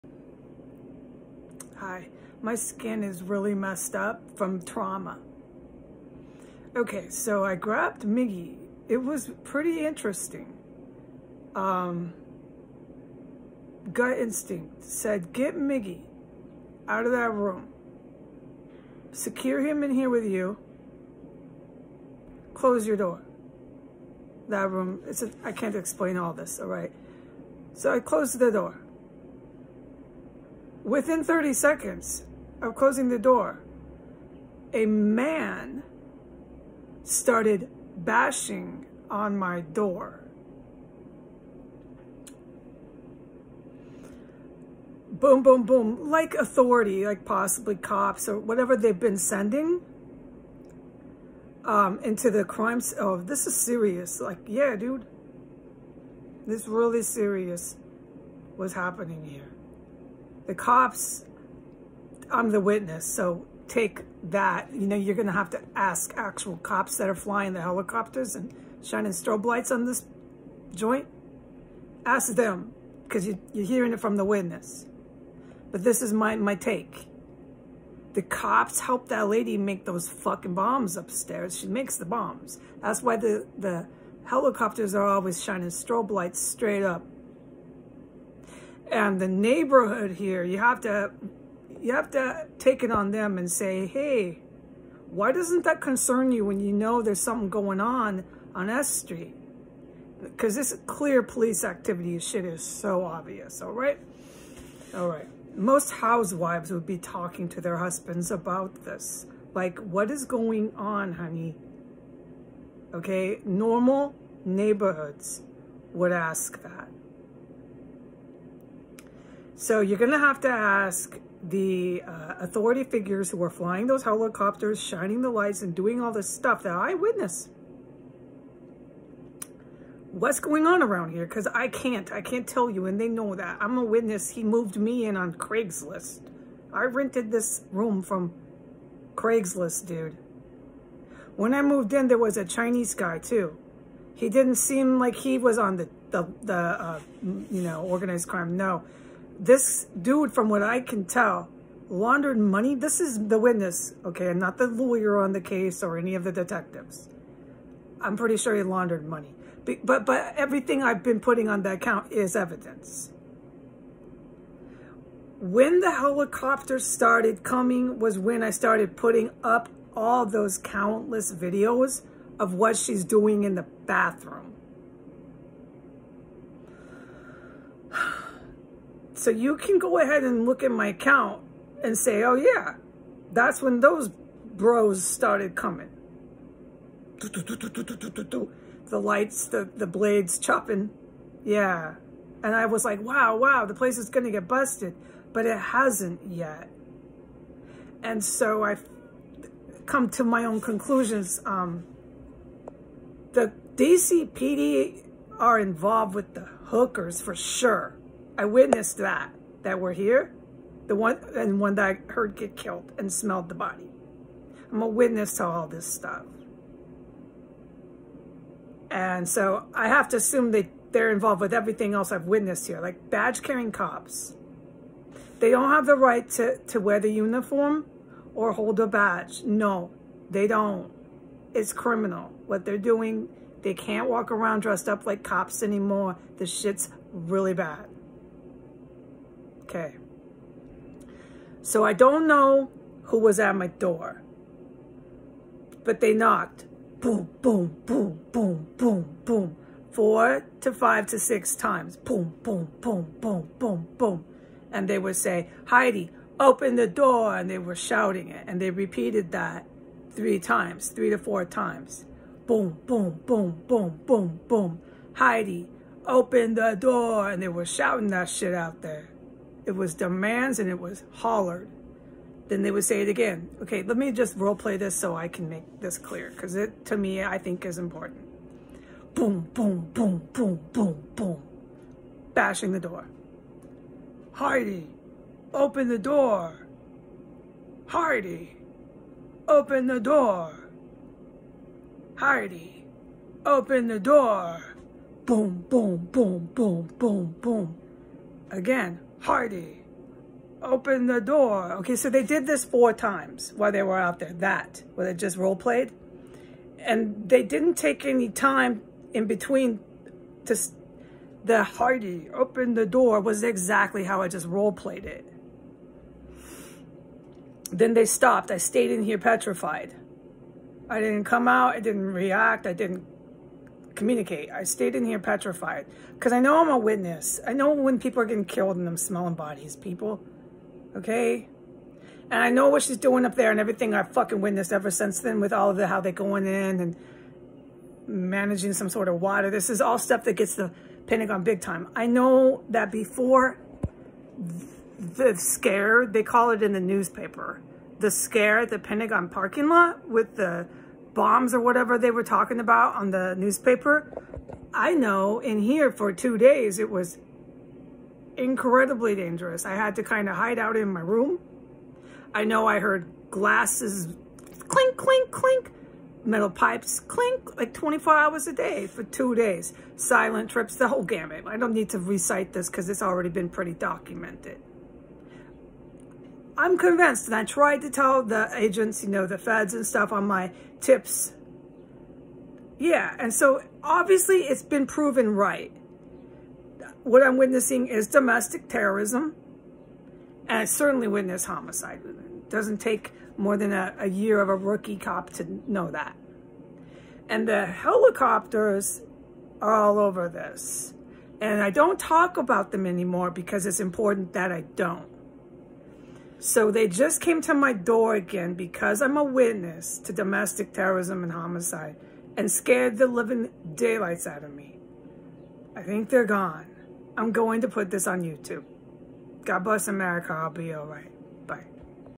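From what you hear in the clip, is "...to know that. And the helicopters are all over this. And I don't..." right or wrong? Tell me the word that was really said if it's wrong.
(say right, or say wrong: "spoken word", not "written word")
right.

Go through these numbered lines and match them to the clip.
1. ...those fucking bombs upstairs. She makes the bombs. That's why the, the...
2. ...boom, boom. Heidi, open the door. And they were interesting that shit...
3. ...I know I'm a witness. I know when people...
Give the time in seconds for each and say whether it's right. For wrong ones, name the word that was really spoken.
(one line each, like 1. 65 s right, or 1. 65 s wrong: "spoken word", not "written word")
1. 79 s right
2. 264 s wrong: "shouting", not "interesting"
3. 326 s right.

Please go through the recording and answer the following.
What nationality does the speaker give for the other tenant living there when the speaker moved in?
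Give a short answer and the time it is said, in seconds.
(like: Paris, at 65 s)
Chinese, at 142 s.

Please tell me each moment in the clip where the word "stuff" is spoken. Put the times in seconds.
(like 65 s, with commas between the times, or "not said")
126 s, 215 s, 339 s, 379 s.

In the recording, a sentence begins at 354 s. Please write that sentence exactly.
I know in here for two days it was incredibly dangerous.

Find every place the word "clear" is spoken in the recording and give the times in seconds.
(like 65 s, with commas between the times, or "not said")
100 s, 275 s.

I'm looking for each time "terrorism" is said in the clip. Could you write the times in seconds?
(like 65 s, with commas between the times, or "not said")
388 s, 410 s.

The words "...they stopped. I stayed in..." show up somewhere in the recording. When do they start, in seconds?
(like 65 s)
317 s.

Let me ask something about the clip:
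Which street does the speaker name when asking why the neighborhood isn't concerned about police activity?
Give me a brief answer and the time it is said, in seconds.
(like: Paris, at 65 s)
S Street, at 98 s.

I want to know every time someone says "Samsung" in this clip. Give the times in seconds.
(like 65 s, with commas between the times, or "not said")
not said.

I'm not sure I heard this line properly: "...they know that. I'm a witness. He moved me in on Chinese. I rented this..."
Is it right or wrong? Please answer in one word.
wrong.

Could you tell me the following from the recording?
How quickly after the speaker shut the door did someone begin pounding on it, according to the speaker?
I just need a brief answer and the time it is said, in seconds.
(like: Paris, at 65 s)
30 seconds, at 31 s.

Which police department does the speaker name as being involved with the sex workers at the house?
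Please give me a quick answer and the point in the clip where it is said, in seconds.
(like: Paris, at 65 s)
DCPD, at 203 s.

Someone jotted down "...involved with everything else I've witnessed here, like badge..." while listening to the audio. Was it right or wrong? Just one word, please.
right.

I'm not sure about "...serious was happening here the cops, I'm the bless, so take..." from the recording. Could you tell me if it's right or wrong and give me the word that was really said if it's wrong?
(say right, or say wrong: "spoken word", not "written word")
wrong: "witness", not "bless".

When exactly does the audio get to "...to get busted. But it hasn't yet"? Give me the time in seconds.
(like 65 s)
194 s.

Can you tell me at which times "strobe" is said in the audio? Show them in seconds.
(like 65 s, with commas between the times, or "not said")
69 s, 85 s.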